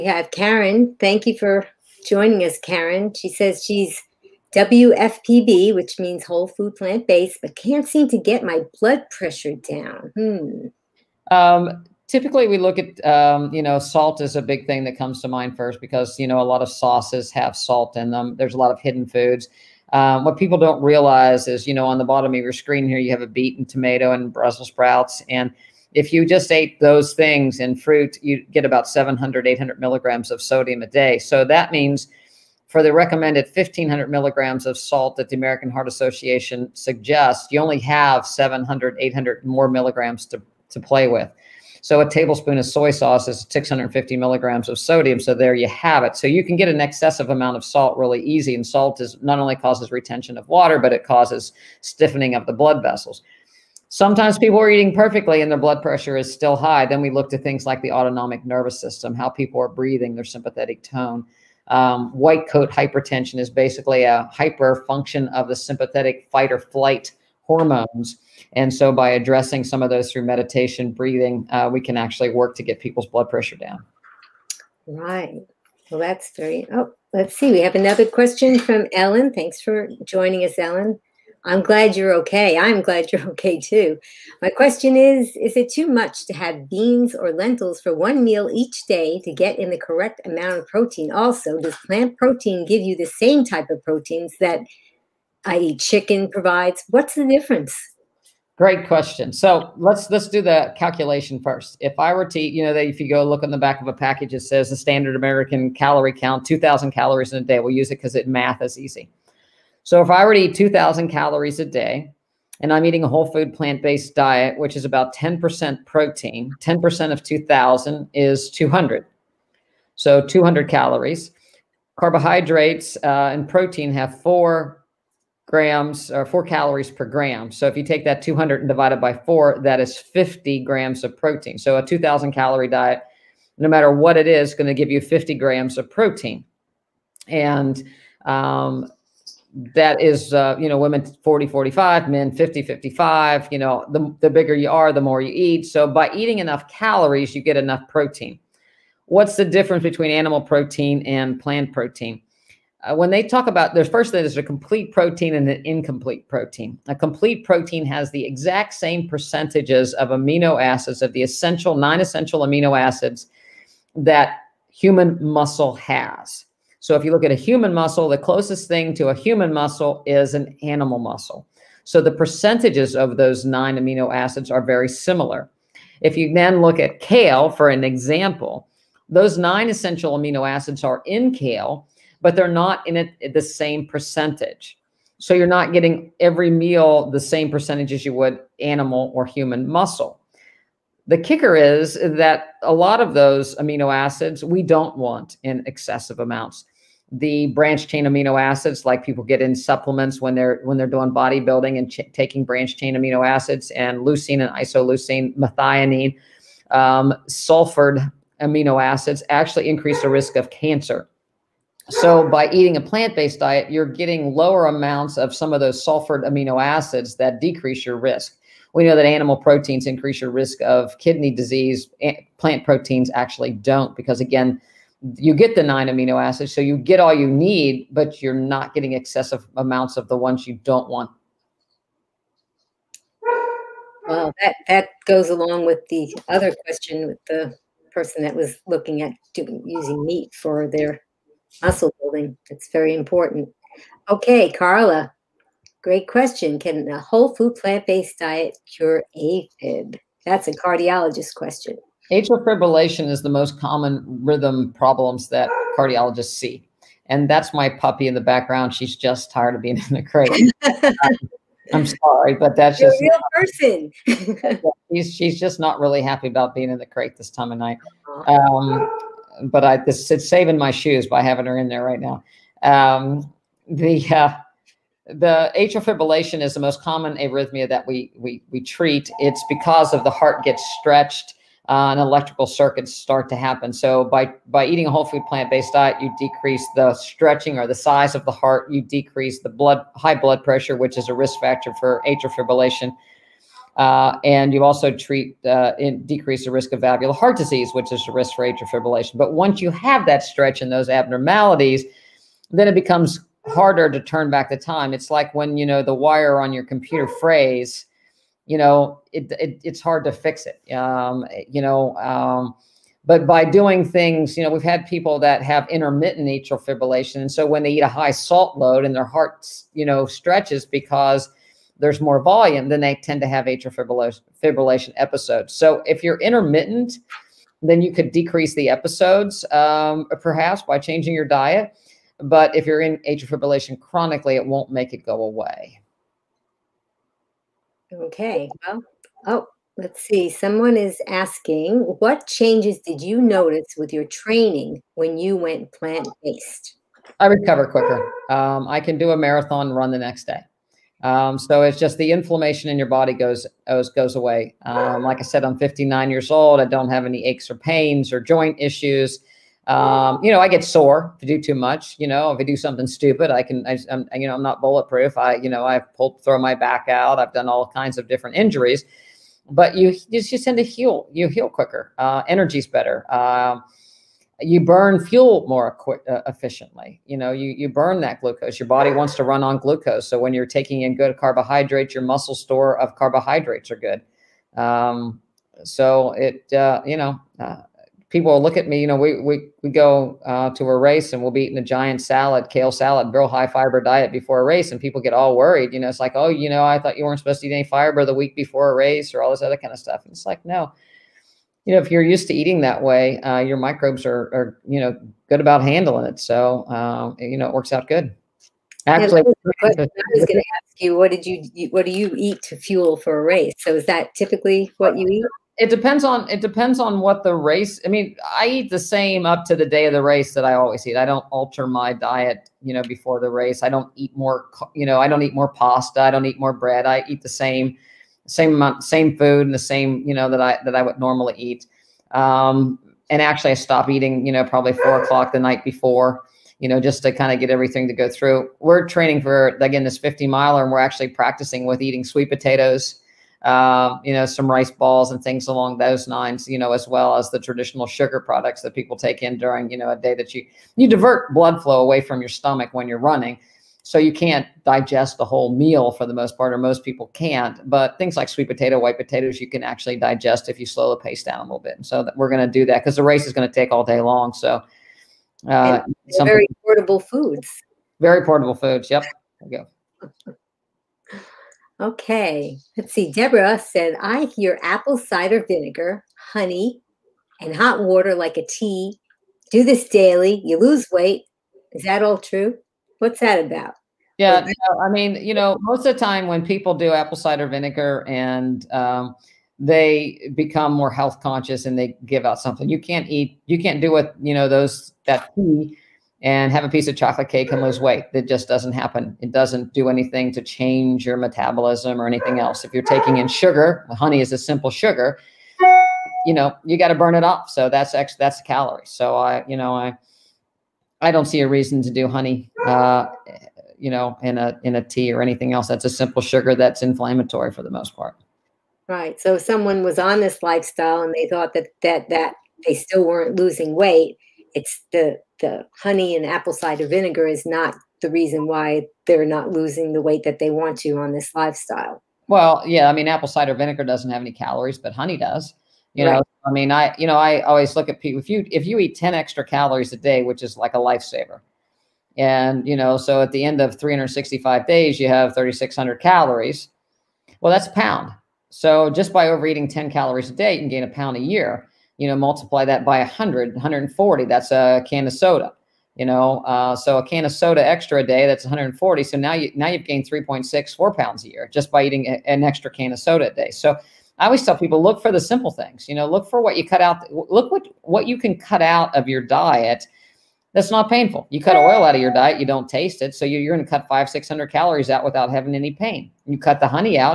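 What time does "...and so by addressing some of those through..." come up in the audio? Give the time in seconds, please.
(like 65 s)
68 s.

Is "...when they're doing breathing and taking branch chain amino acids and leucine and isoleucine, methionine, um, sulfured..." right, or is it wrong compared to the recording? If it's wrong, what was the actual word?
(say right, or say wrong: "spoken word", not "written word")
wrong: "bodybuilding", not "breathing".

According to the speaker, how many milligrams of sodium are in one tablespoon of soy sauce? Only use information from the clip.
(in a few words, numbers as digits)
650 milligrams.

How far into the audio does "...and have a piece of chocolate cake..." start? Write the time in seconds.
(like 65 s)
496 s.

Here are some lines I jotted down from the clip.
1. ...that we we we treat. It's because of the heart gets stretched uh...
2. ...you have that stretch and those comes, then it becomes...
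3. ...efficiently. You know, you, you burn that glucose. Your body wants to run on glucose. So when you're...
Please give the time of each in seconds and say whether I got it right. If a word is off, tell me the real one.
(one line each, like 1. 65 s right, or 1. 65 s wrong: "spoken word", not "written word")
1. 277 s right
2. 299 s wrong: "abnormalities", not "comes"
3. 376 s right.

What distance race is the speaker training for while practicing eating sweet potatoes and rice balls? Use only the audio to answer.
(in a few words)
50 miles.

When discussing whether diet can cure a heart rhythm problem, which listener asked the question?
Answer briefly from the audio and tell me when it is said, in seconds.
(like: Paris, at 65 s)
Carla, at 244 s.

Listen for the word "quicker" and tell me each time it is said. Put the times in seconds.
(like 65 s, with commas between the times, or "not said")
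347 s, 371 s.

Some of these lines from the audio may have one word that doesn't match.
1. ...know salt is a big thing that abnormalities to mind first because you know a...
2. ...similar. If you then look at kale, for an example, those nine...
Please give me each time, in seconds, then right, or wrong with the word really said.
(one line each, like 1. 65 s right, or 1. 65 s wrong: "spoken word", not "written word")
1. 13 s wrong: "comes", not "abnormalities"
2. 174 s right.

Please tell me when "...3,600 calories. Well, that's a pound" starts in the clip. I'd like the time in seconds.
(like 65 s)
545 s.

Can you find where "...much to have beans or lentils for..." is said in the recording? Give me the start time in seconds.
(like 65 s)
85 s.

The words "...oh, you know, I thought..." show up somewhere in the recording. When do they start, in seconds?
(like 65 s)
396 s.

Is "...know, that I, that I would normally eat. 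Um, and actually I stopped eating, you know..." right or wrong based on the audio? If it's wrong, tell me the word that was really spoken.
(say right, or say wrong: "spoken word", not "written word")
right.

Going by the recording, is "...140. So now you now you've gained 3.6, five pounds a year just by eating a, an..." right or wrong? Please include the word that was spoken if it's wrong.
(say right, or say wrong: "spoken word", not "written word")
wrong: "four", not "five".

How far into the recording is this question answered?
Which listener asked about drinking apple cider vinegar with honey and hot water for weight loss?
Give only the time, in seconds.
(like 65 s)
473 s.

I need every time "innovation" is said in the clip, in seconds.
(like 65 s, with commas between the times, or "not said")
not said.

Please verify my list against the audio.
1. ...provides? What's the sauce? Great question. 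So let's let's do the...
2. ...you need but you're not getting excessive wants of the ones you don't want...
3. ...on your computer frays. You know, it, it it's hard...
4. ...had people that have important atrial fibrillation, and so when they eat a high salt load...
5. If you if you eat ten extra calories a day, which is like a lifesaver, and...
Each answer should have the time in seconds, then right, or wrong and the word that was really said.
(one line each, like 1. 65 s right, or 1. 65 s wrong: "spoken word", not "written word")
1. 96 s wrong: "difference", not "sauce"
2. 227 s wrong: "amounts", not "wants"
3. 306 s right
4. 314 s wrong: "intermittent", not "important"
5. 538 s right.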